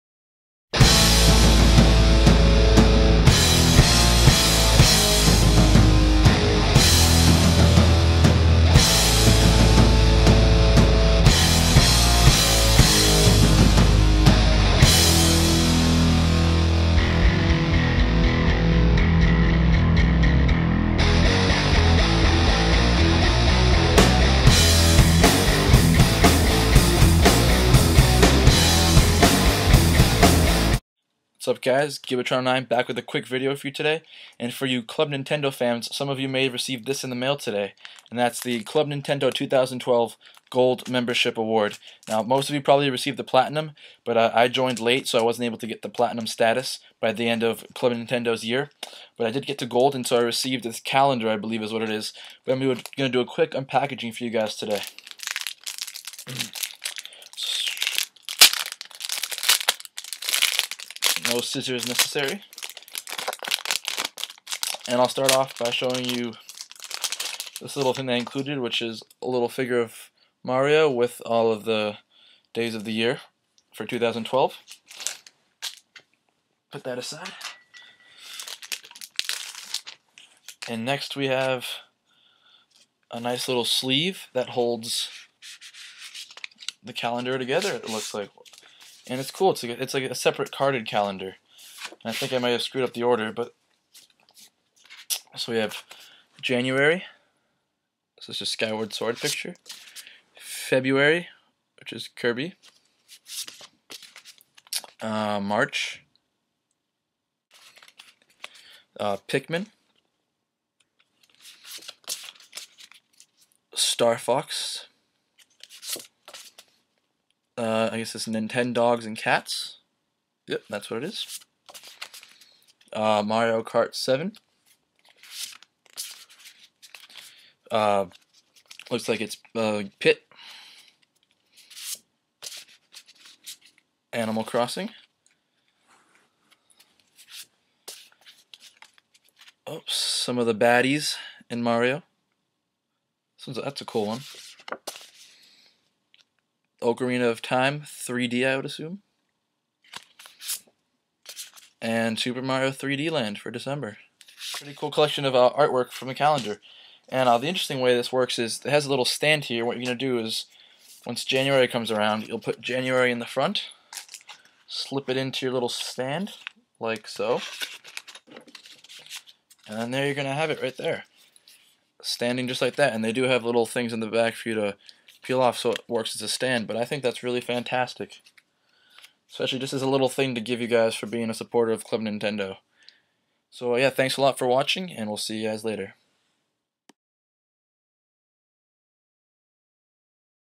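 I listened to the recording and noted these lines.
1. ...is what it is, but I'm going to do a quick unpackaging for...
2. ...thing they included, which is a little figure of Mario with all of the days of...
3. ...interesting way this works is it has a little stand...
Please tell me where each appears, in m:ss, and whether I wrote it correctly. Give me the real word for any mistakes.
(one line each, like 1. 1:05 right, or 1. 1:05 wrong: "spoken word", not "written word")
1. 0:51 right
2. 1:07 right
3. 2:37 right.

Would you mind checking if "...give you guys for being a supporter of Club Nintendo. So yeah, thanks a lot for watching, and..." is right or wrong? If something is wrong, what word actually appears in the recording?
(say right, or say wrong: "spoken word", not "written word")
right.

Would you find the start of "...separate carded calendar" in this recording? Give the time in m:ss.
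1:30.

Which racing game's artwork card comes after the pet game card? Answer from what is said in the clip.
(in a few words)
Mario Kart 7.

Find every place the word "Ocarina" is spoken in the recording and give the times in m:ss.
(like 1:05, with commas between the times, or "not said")
2:26.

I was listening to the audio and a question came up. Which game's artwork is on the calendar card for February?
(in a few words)
Kirby.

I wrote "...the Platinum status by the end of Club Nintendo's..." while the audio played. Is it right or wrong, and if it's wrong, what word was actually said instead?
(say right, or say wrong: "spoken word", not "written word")
right.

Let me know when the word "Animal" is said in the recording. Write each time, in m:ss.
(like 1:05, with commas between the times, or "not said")
2:14.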